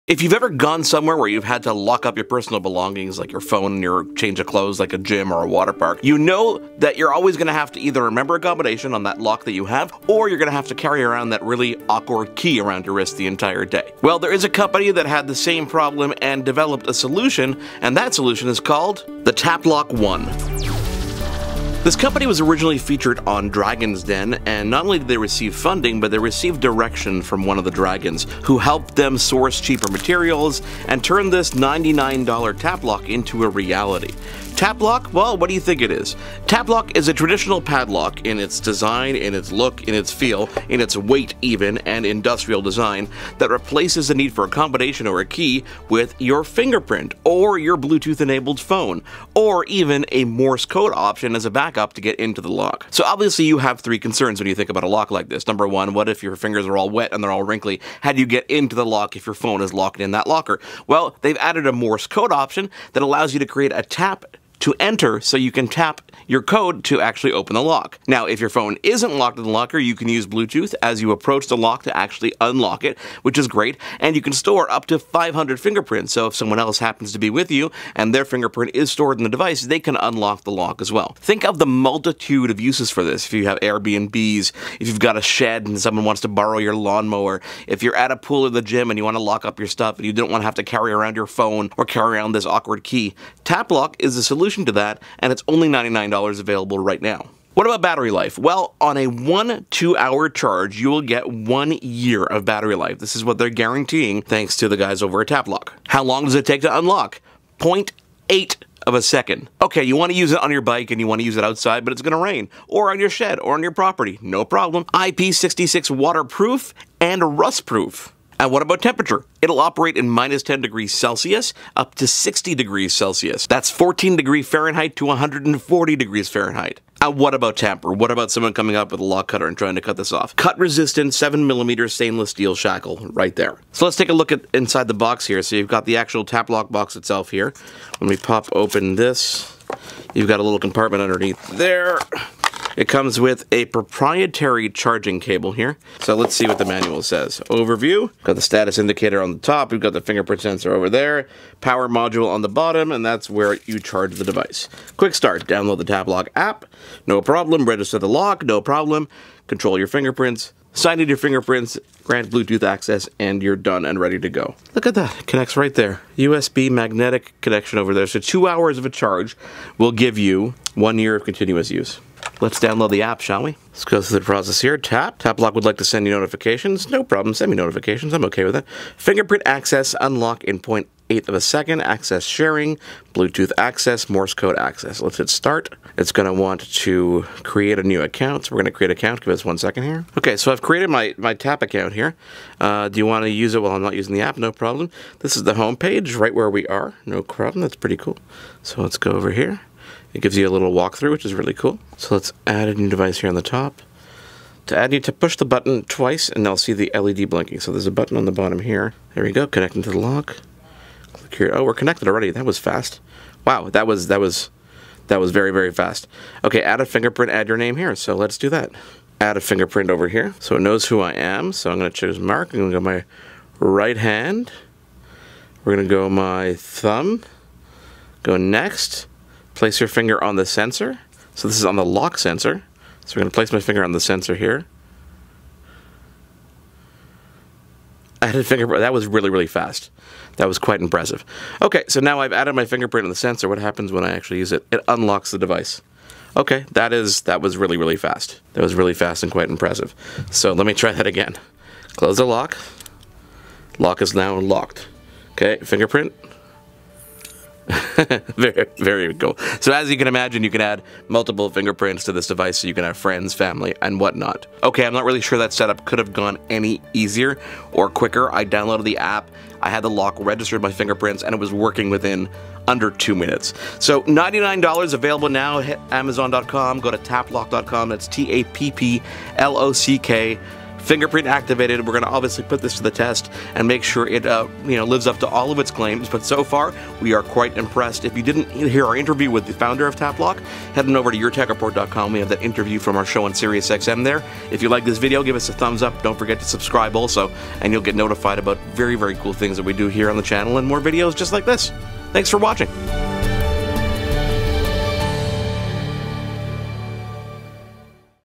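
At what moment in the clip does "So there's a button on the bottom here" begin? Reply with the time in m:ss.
3:27.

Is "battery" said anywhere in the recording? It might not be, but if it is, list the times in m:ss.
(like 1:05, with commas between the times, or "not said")
1:37, 1:42.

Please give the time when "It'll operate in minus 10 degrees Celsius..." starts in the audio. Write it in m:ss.
1:59.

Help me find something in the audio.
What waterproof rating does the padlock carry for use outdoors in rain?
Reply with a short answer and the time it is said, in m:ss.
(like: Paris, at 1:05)
IP66, at 1:54.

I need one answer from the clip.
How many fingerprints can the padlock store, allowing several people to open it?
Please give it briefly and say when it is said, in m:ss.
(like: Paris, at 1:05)
500, at 1:14.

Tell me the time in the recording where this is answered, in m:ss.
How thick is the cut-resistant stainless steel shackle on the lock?
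2:11.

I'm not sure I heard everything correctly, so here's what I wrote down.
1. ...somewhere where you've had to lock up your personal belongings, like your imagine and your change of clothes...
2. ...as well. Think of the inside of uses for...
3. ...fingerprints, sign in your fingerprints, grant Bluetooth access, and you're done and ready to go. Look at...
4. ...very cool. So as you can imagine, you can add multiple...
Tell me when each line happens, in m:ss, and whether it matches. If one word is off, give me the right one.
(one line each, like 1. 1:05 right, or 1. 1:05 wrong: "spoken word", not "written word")
1. 0:00 wrong: "phone", not "imagine"
2. 1:20 wrong: "multitude", not "inside"
3. 2:39 right
4. 4:18 right.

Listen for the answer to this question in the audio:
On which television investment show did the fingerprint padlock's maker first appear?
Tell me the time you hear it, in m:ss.
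0:23.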